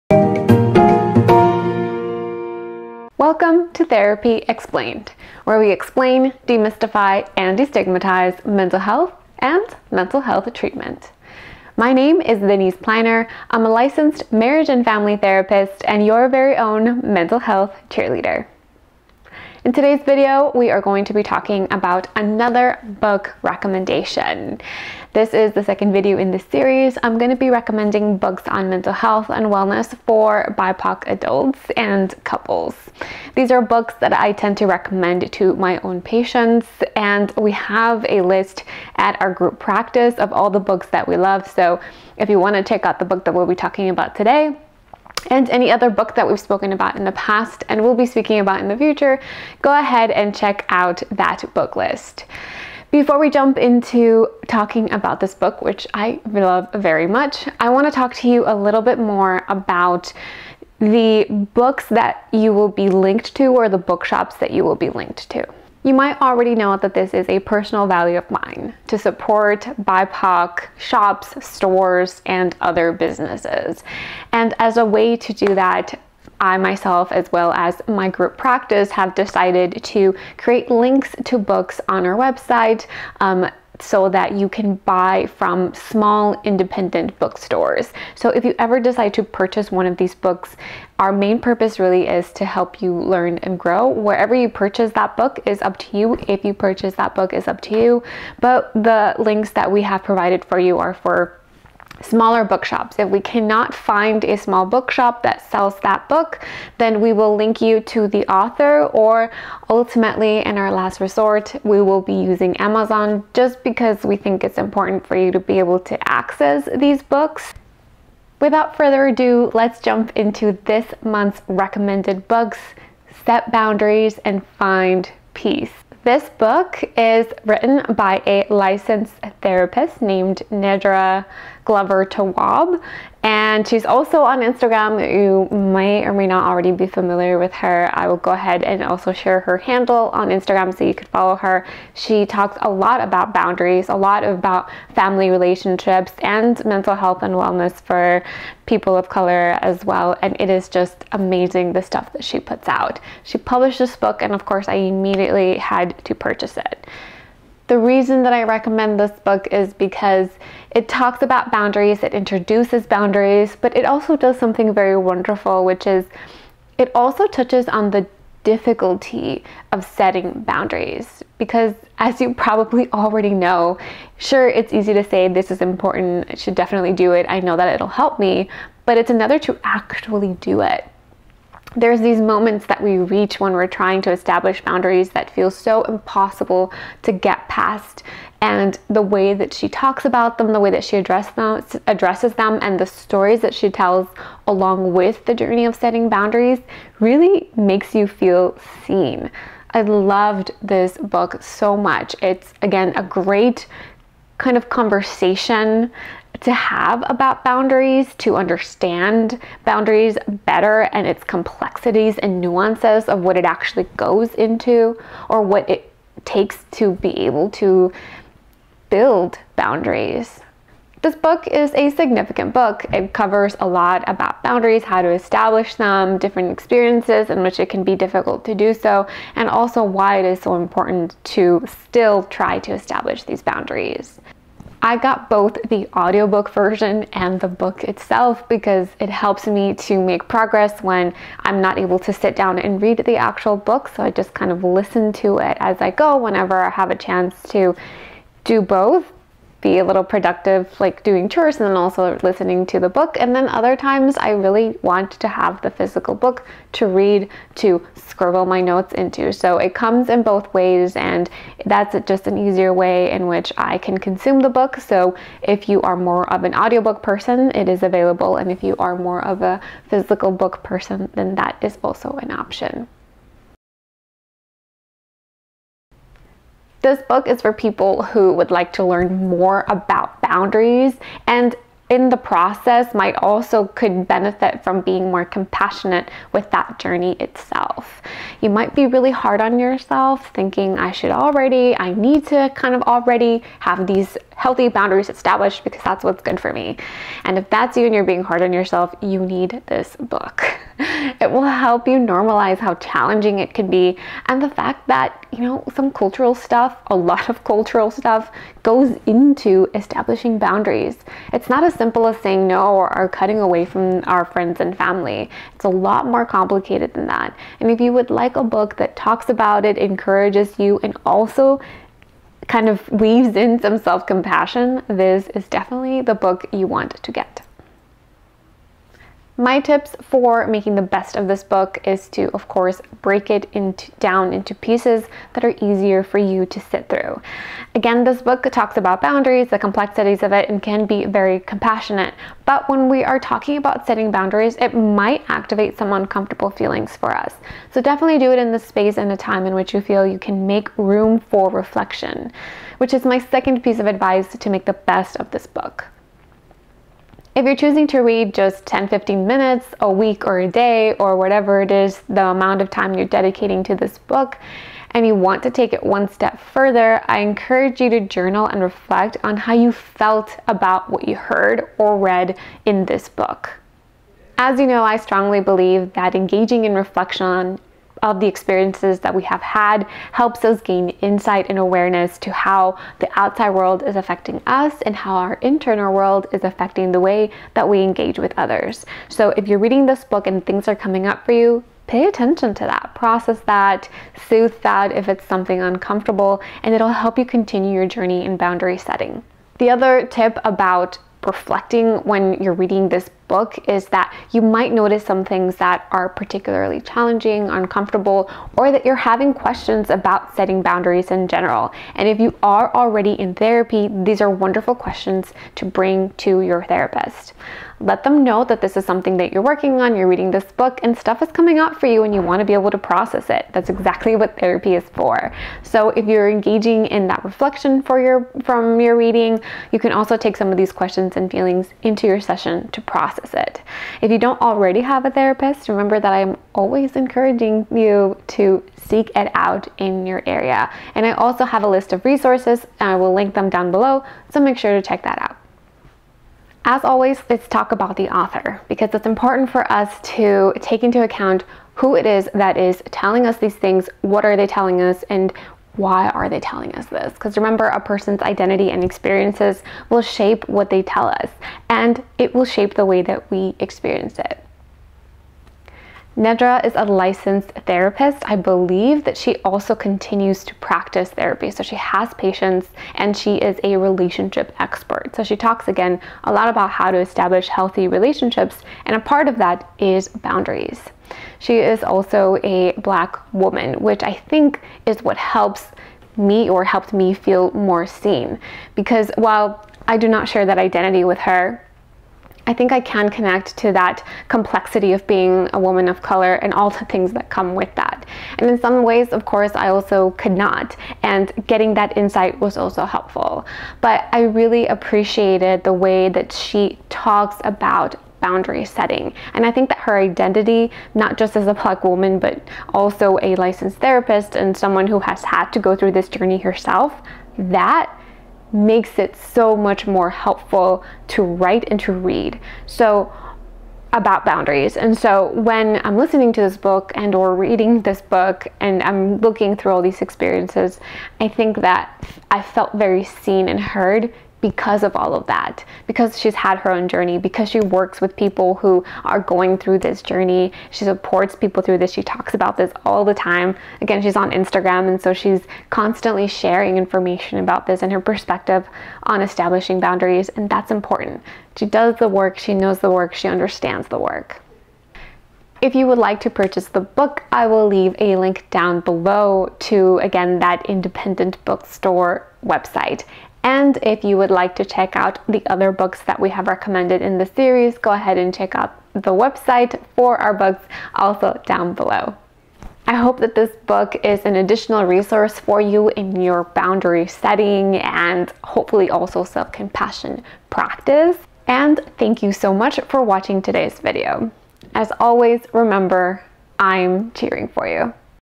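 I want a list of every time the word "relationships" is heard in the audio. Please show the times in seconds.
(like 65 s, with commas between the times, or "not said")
145 s, 473 s, 477 s.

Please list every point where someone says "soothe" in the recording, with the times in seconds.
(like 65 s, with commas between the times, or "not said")
394 s.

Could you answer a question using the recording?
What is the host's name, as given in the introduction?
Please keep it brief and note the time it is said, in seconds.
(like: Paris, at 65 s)
Deniss Pleiner, at 12 s.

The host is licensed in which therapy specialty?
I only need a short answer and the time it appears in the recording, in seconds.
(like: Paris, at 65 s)
Marriage and family therapist, at 14 s.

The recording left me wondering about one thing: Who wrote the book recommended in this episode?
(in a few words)
Nedra Glover Tawwab.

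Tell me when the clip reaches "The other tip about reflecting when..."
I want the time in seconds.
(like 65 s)
399 s.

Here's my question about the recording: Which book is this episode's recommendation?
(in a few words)
Set Boundaries and Find Peace.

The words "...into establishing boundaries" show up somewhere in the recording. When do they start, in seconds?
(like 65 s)
309 s.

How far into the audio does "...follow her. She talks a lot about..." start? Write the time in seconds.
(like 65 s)
141 s.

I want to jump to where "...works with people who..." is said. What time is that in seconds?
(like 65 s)
537 s.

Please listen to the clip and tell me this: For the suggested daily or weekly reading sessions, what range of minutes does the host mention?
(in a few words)
10-15 minutes.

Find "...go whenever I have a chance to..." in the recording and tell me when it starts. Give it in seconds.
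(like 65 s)
245 s.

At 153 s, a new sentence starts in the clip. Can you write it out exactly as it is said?
She published this book, and of course, I immediately had to purchase it.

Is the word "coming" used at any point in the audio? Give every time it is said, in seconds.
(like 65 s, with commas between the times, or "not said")
390 s, 421 s.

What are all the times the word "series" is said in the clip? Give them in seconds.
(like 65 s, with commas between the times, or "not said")
26 s, 567 s.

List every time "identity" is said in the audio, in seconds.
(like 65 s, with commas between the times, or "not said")
458 s, 490 s, 509 s.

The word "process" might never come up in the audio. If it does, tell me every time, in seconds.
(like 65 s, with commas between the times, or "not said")
282 s, 392 s, 422 s, 432 s.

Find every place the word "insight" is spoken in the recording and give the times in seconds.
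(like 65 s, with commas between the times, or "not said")
381 s, 501 s.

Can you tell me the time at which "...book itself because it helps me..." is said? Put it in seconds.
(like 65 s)
237 s.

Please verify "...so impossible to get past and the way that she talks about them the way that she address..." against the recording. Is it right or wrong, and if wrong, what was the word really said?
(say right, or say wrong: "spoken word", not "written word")
right.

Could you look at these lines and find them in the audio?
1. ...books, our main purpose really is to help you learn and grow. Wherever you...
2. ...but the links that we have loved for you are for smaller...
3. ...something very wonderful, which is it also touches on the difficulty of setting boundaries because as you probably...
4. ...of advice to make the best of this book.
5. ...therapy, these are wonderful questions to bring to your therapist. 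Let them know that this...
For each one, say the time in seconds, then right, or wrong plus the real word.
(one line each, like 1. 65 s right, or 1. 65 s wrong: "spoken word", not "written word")
1. 90 s right
2. 98 s wrong: "provided", not "loved"
3. 164 s right
4. 353 s right
5. 413 s right.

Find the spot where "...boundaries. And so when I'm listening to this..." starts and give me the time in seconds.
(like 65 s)
524 s.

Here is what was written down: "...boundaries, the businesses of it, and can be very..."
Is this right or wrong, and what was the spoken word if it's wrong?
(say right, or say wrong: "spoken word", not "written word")
wrong: "complexities", not "businesses".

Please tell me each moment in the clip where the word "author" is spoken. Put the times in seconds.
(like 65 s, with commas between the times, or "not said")
108 s, 448 s.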